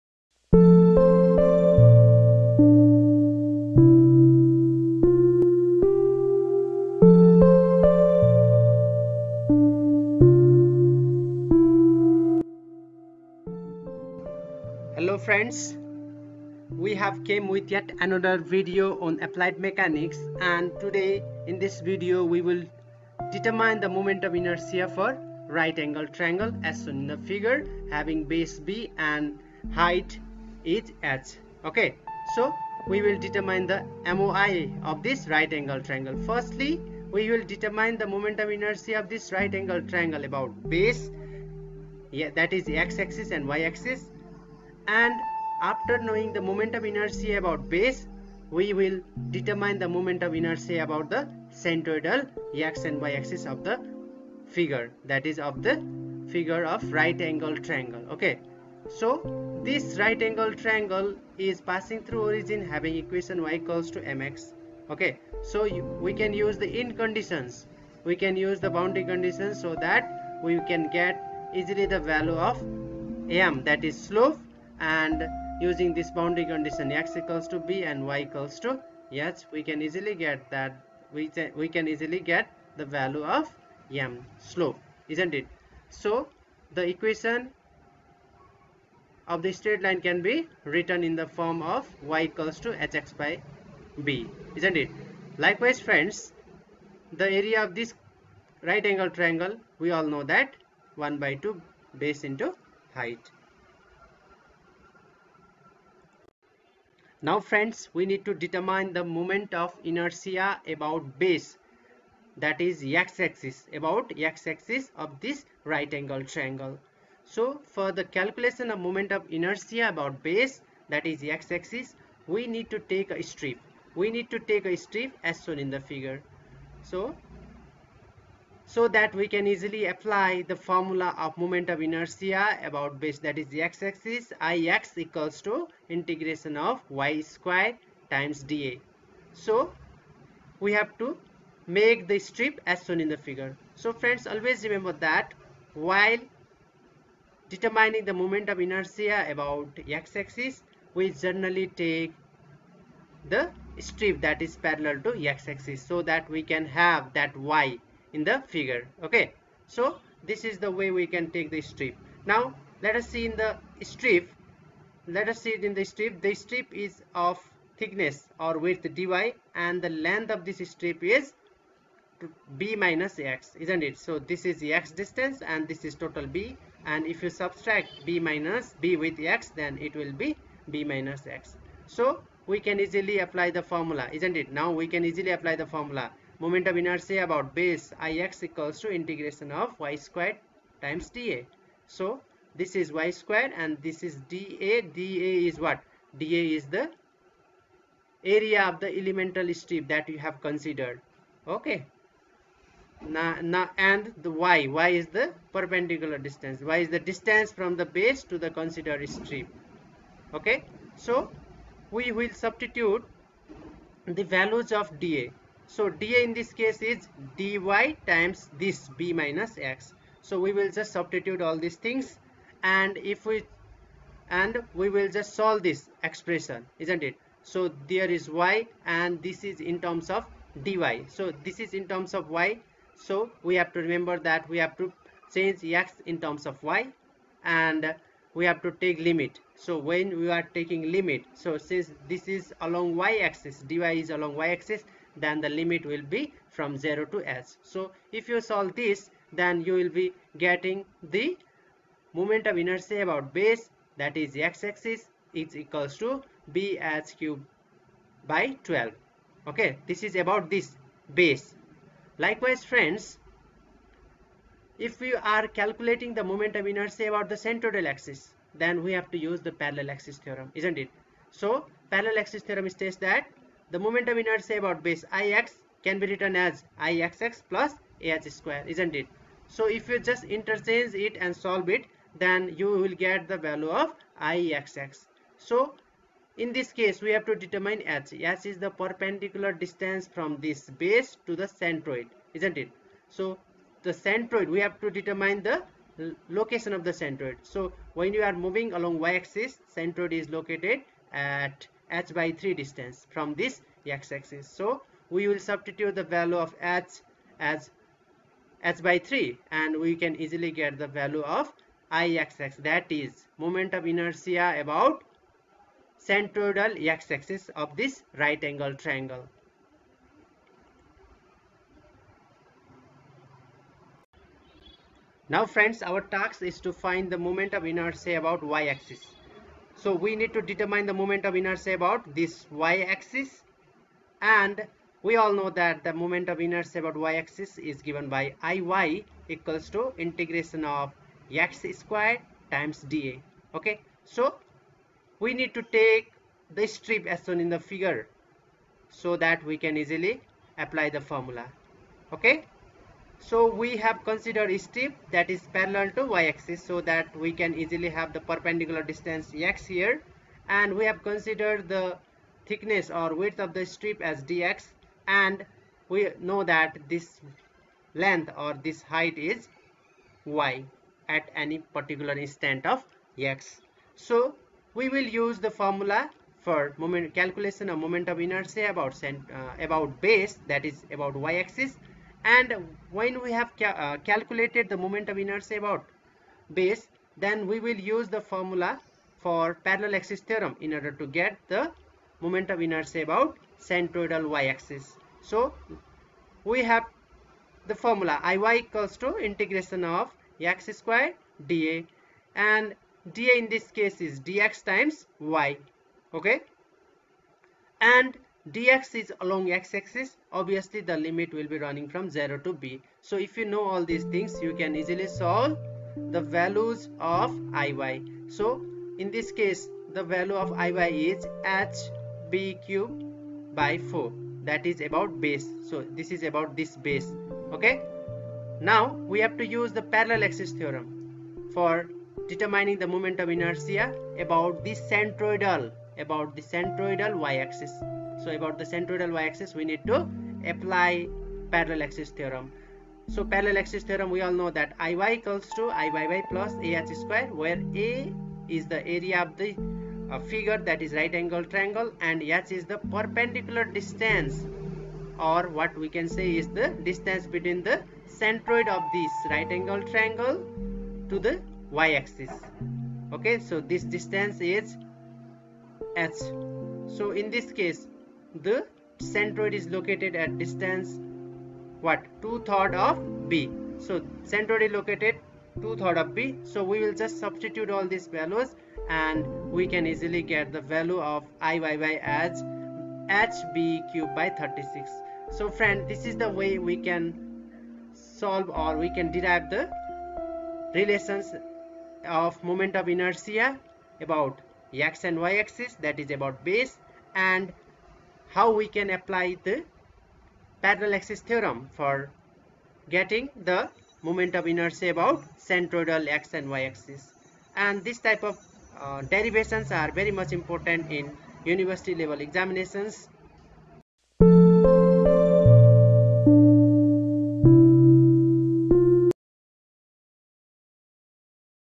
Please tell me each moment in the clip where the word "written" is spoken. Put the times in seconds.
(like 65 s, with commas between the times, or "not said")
90 s, 276 s.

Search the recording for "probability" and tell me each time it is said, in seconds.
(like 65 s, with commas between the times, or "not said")
not said.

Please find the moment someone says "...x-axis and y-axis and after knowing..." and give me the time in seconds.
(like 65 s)
42 s.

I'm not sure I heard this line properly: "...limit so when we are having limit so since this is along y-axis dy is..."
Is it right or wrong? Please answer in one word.
wrong.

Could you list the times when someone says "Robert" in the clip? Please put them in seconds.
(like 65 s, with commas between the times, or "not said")
not said.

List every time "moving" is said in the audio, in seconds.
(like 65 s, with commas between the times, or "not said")
298 s.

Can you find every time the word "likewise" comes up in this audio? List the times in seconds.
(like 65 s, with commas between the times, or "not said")
95 s, 262 s.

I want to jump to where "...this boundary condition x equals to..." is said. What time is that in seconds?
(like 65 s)
75 s.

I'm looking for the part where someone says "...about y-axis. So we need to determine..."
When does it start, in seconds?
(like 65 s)
328 s.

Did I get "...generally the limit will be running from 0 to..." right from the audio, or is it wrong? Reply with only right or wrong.
wrong.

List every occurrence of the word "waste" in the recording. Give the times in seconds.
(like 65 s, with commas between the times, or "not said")
not said.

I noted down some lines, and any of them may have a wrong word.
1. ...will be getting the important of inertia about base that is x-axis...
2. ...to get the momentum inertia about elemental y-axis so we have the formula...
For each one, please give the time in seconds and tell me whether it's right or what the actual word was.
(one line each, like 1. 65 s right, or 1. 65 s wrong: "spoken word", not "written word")
1. 249 s wrong: "moment", not "important"
2. 391 s wrong: "centroidal", not "elemental".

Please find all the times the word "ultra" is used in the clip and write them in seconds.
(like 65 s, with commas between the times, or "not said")
not said.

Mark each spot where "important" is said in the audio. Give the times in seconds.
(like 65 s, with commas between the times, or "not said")
510 s.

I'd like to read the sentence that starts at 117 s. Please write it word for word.
So for the calculation of moment of inertia about base that is x-axis, we need to take a strip.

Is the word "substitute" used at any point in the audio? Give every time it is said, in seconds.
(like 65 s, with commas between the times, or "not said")
212 s, 220 s, 305 s, 477 s.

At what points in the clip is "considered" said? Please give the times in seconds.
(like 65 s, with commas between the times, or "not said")
200 s, 208 s, 354 s, 361 s.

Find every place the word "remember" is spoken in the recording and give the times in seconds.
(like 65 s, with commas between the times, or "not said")
144 s, 233 s.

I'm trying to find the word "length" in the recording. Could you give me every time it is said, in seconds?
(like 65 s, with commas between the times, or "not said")
169 s, 367 s.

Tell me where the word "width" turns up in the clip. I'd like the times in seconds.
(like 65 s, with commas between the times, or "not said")
168 s, 363 s.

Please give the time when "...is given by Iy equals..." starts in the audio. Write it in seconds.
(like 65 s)
337 s.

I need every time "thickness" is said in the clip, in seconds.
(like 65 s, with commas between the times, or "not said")
167 s, 362 s.